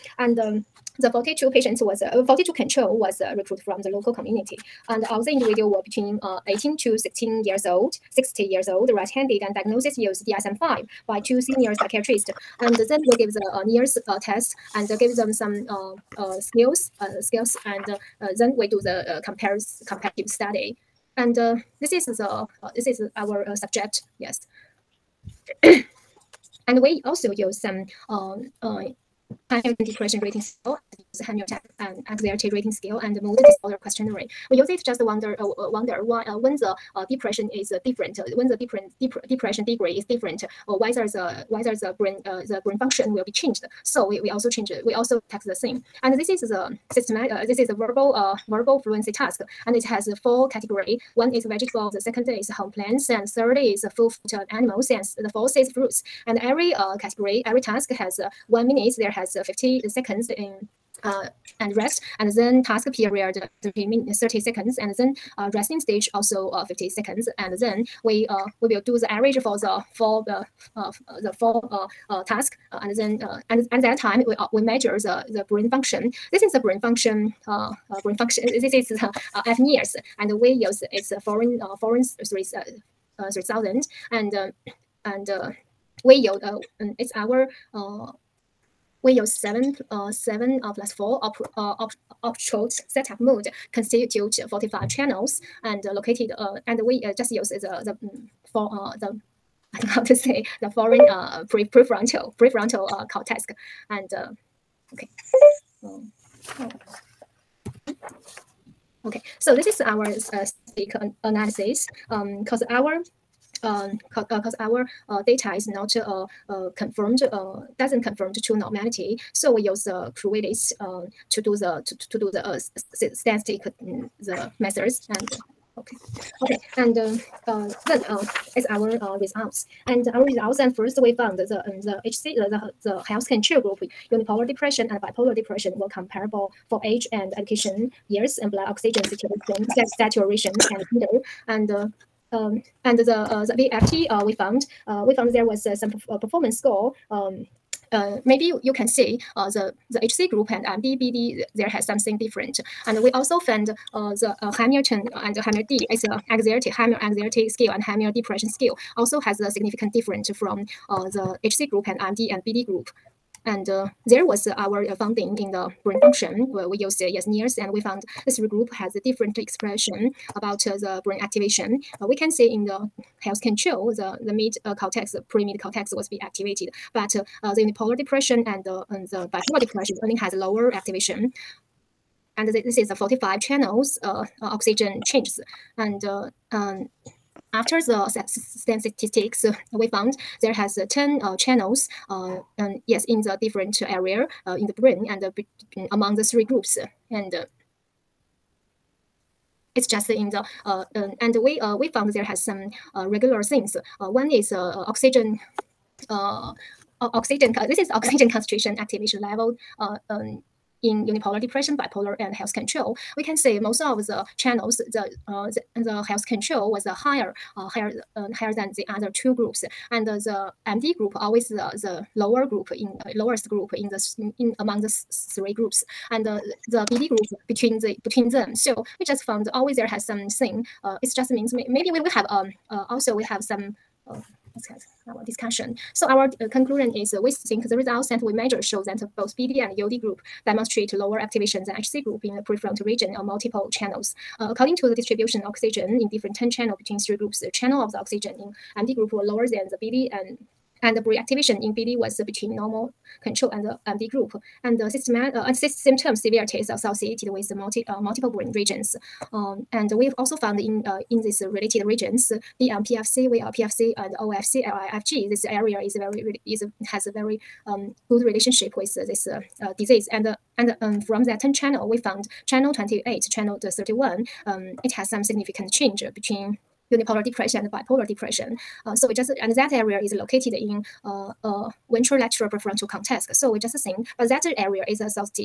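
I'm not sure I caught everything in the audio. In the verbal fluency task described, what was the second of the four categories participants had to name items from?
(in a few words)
home plants.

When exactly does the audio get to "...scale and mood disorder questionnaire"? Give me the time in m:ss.
0:32.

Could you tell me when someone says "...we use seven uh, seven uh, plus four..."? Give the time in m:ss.
1:29.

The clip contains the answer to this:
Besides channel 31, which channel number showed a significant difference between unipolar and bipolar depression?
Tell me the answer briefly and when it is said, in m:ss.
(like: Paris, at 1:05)
channel 28, at 4:32.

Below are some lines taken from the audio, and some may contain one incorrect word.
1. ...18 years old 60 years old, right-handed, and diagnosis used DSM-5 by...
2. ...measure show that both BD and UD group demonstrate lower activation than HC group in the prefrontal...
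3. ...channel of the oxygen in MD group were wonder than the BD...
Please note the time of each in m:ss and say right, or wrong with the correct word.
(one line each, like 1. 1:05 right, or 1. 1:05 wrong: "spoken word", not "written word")
1. 0:06 wrong: "16", not "18"
2. 3:58 right
3. 4:07 wrong: "lower", not "wonder".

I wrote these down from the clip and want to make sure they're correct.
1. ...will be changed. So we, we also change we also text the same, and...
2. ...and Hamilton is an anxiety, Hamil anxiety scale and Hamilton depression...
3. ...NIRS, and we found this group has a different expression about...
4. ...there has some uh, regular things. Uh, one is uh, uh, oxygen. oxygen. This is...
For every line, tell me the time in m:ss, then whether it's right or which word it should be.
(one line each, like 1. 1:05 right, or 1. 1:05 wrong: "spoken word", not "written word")
1. 0:43 right
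2. 2:35 right
3. 2:47 right
4. 3:22 right.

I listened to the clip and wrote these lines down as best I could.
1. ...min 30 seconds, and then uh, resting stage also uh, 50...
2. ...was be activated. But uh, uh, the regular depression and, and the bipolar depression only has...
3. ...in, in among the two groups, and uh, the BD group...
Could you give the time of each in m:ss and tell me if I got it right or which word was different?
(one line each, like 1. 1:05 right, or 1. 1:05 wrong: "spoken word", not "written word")
1. 1:03 right
2. 2:55 wrong: "unipolar", not "regular"
3. 3:44 wrong: "three", not "two".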